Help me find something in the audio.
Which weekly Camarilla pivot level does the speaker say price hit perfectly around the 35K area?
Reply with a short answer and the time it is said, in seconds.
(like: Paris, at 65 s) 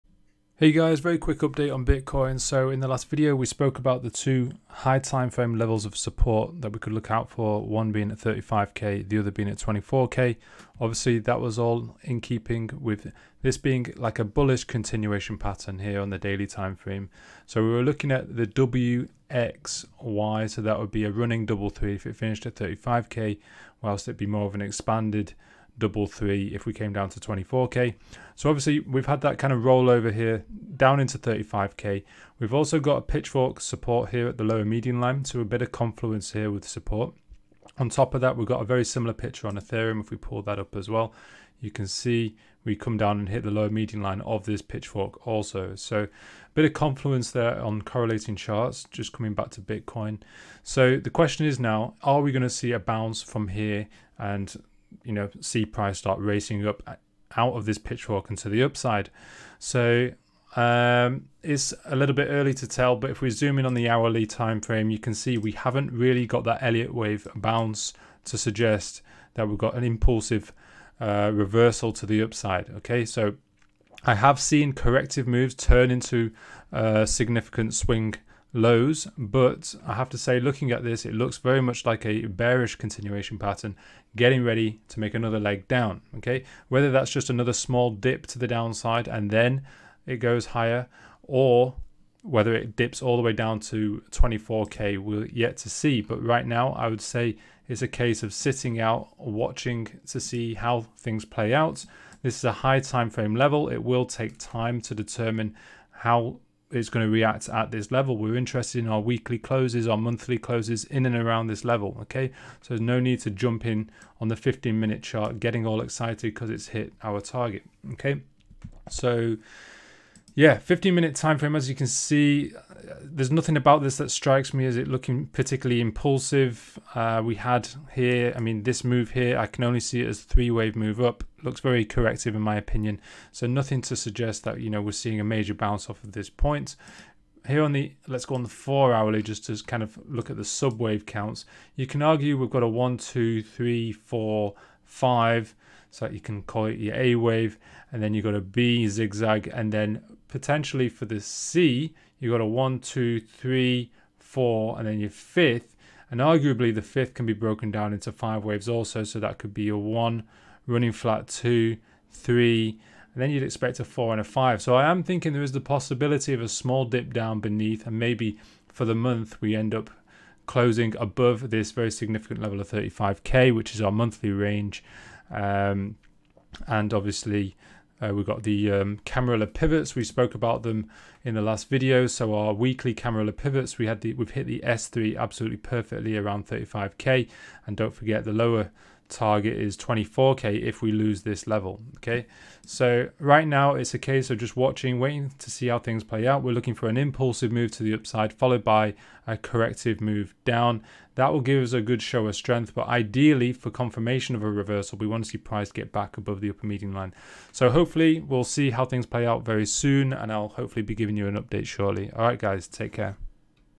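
S3, at 184 s.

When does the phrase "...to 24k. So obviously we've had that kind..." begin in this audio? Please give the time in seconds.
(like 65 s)
27 s.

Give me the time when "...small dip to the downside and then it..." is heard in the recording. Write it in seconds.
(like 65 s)
87 s.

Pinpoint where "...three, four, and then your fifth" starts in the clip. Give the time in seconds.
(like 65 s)
153 s.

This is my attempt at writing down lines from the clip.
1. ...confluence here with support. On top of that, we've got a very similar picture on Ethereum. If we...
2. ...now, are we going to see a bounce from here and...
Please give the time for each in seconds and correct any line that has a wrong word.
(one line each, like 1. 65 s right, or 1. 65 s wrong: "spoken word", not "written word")
1. 35 s right
2. 51 s right.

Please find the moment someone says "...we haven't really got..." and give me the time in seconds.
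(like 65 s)
65 s.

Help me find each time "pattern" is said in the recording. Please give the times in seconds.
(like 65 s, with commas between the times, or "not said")
15 s, 83 s.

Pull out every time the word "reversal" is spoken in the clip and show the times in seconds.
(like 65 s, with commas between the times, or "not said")
71 s, 204 s.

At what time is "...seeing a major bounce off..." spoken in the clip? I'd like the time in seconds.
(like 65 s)
134 s.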